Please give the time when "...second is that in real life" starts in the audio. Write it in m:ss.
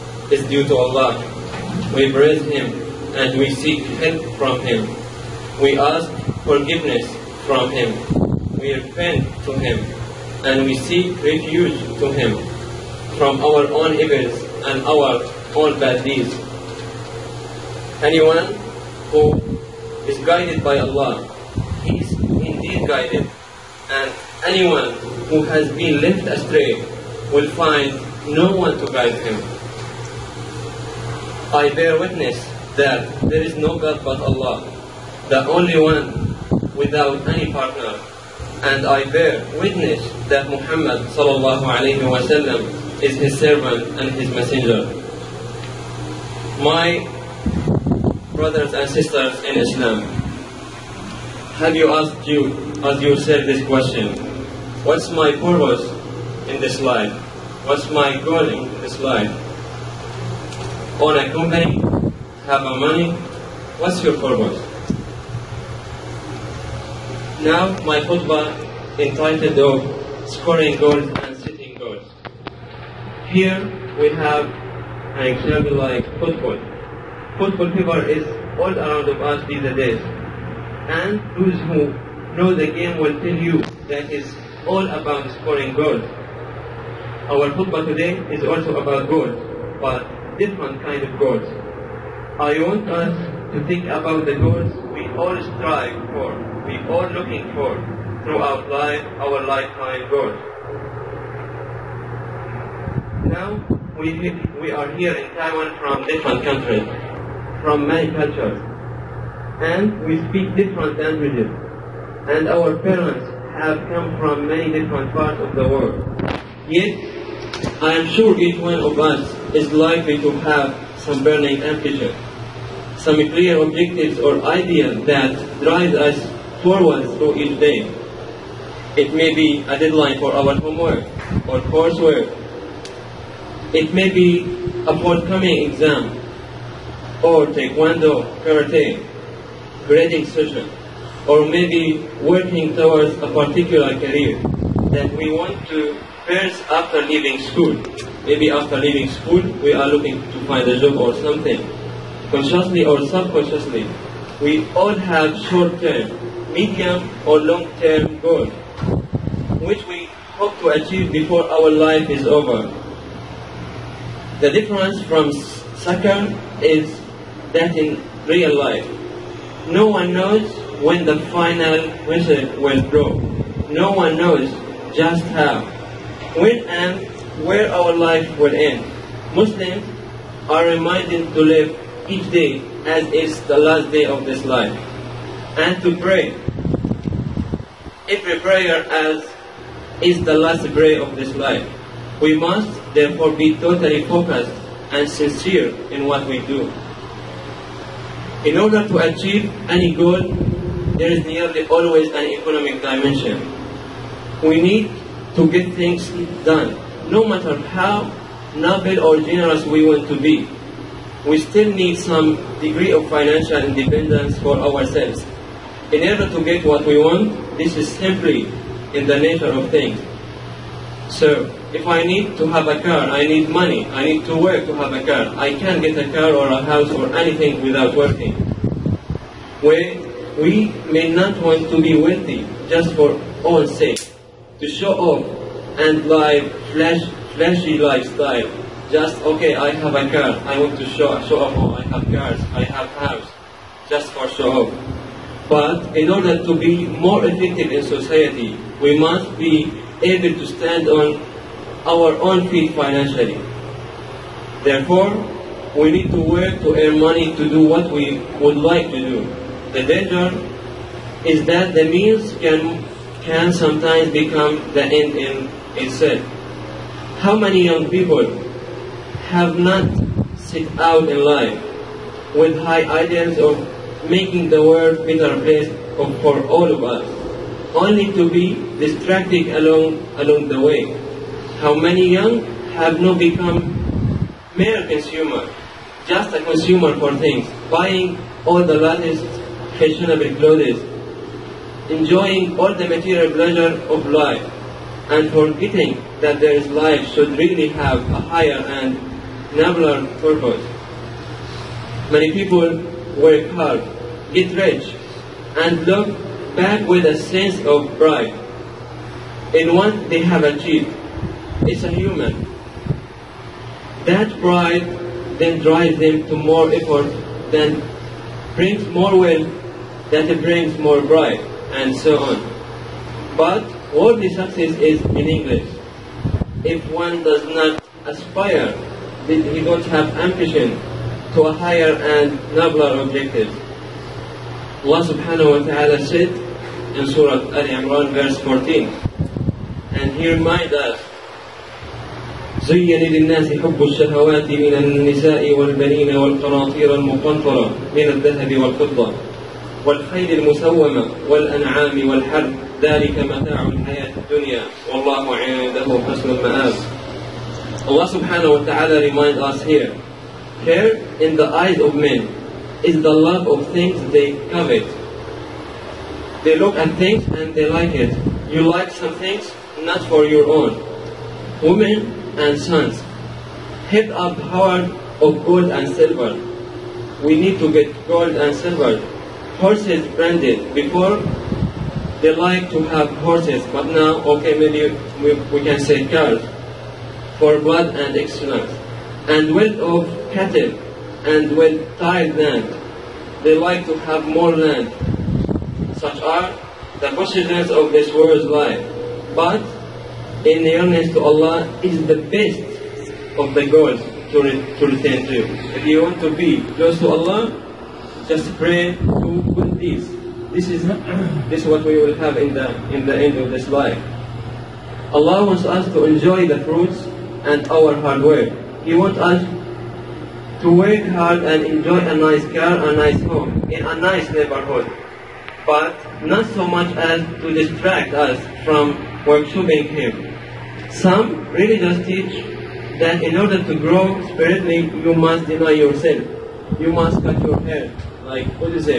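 2:45.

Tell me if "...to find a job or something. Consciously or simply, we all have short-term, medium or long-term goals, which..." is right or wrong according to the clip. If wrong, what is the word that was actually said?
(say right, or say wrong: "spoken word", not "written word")
wrong: "subconsciously", not "simply".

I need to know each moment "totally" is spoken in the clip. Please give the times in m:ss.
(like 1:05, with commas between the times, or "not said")
3:13.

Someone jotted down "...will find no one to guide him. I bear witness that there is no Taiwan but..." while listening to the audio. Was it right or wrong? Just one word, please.
wrong.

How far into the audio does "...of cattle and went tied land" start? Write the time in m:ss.
6:29.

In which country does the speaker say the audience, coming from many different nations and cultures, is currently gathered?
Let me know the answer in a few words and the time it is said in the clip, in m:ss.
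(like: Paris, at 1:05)
Taiwan, at 1:45.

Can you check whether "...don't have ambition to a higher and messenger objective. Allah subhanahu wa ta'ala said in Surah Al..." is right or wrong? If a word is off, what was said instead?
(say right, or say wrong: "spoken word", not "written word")
wrong: "nobler", not "messenger".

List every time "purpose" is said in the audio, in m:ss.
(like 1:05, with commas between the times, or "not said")
0:55, 1:04, 5:00.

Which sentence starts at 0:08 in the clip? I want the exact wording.
We repent to Him and we seek refuge to Him from our own evils and our own bad deeds.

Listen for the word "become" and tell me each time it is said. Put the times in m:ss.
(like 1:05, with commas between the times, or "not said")
4:24, 4:43.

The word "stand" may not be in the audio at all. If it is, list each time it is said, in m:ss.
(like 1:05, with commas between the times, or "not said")
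4:10.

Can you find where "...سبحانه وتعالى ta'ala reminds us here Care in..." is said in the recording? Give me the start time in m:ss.
5:58.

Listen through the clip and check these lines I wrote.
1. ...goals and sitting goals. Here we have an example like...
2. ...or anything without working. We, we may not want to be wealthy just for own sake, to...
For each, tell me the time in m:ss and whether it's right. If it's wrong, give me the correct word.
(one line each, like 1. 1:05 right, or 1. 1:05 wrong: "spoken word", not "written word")
1. 1:10 right
2. 3:46 right.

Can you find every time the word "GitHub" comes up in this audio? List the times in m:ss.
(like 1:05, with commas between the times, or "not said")
not said.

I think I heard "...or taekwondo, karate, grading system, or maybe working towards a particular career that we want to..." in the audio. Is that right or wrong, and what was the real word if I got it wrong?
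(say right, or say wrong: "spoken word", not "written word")
right.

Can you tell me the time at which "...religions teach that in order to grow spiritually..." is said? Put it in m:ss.
7:11.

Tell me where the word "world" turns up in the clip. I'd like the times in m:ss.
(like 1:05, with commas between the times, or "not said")
1:55, 4:34, 6:38.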